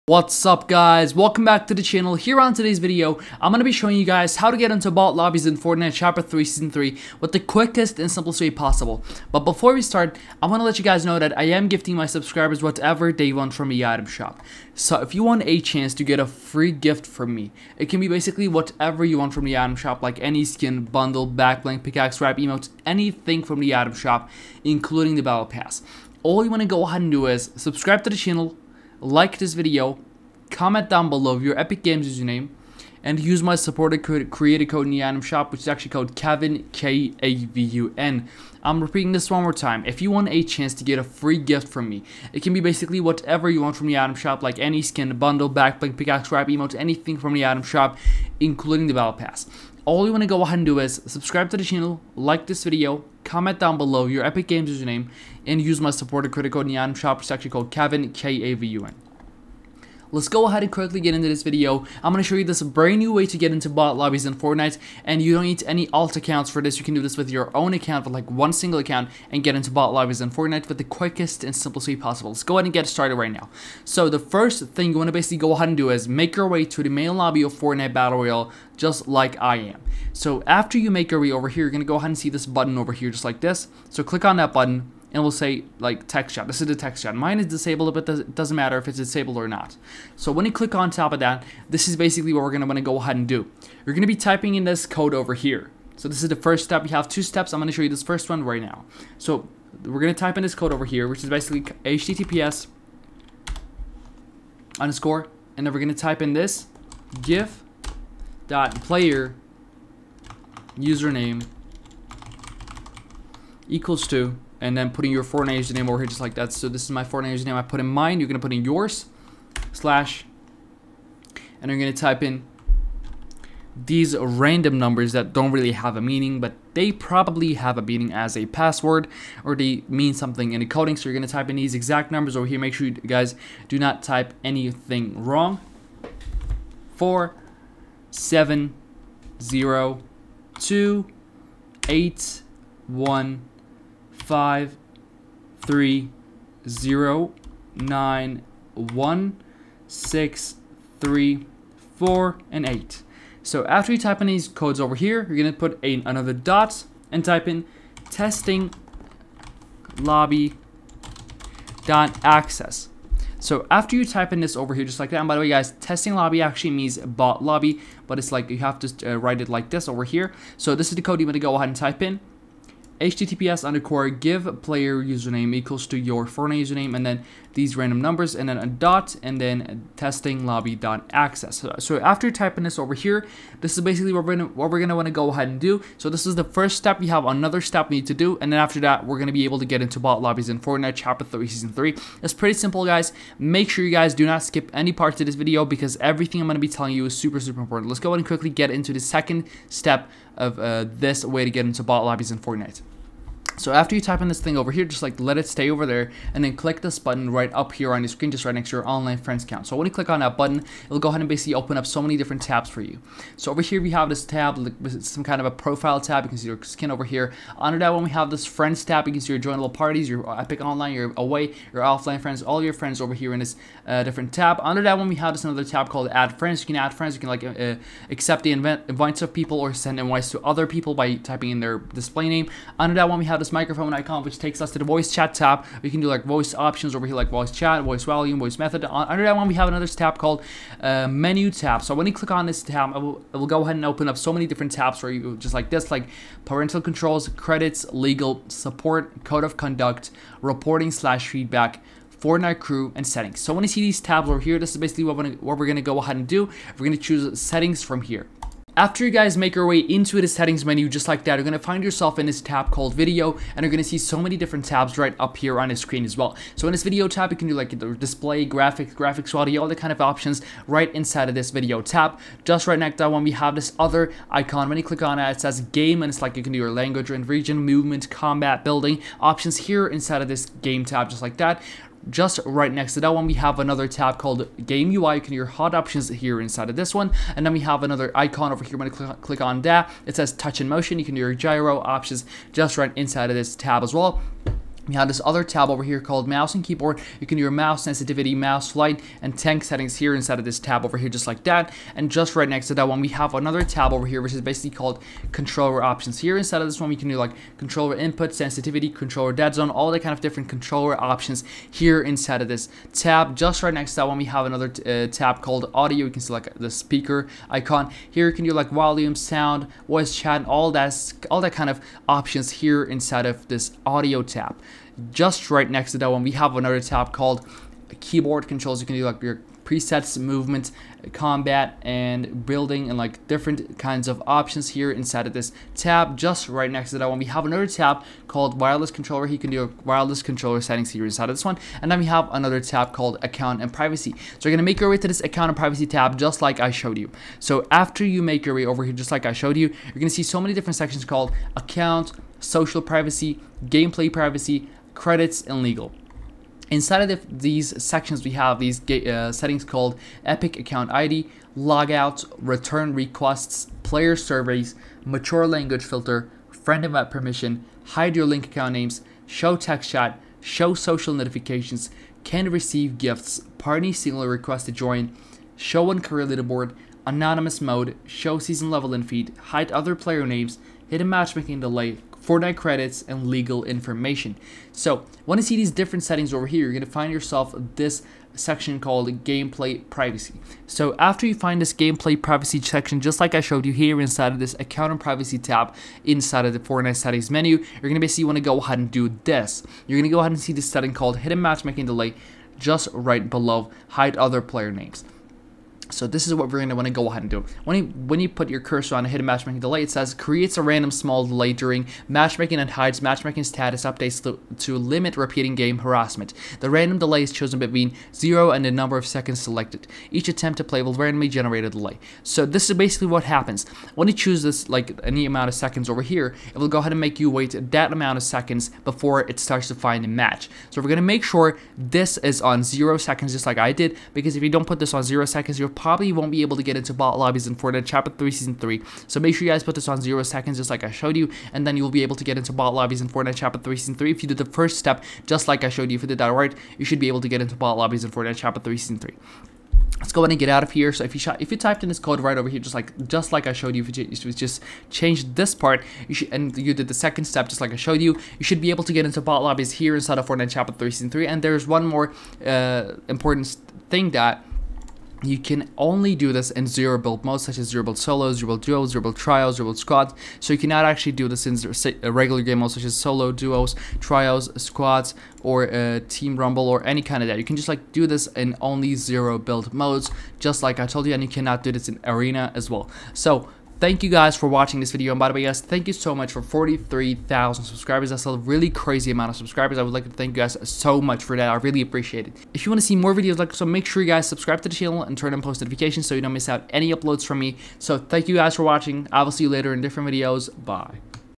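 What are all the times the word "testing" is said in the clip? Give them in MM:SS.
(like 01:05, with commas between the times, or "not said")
02:38, 02:45, 02:59.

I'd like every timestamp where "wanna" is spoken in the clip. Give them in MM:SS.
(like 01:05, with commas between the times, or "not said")
01:32, 03:04, 06:38.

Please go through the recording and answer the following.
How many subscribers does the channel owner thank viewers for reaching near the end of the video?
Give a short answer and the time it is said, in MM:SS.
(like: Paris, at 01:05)
43,000, at 08:06.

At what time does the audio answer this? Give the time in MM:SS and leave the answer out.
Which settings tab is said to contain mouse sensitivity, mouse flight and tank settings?
04:56.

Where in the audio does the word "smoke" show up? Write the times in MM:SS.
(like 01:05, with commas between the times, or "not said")
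not said.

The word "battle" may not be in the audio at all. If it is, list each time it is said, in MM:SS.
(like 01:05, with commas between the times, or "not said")
00:25, 00:48, 01:17.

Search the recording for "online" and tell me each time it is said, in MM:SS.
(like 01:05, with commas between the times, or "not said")
03:28, 03:40.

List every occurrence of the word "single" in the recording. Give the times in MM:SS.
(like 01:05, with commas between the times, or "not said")
01:08, 06:13.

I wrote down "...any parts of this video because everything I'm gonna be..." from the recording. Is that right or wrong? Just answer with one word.
right.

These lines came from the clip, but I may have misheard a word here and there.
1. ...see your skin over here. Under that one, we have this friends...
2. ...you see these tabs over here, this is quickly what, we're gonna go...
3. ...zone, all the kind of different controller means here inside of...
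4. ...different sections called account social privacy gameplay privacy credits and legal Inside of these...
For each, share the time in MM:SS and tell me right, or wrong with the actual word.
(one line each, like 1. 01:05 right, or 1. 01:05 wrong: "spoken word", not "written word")
1. 03:36 right
2. 04:13 wrong: "basically", not "quickly"
3. 05:09 wrong: "options", not "means"
4. 05:50 right.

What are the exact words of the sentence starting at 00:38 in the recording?
I'm repeating this one more time.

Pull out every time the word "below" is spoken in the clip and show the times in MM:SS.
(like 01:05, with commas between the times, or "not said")
00:31, 00:53, 06:43.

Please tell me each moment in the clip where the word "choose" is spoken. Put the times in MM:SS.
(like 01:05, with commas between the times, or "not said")
04:16, 07:04.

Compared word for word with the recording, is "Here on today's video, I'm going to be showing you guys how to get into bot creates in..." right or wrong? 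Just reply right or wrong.
wrong.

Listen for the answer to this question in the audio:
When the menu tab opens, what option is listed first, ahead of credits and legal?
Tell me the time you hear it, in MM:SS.
04:06.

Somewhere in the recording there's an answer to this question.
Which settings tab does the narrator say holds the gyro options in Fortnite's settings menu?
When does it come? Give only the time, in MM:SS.
04:50.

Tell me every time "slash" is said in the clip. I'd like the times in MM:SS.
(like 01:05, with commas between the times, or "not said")
01:59, 04:10.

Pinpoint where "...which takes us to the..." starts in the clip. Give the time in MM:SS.
03:54.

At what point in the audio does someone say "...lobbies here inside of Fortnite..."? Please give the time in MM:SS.
07:39.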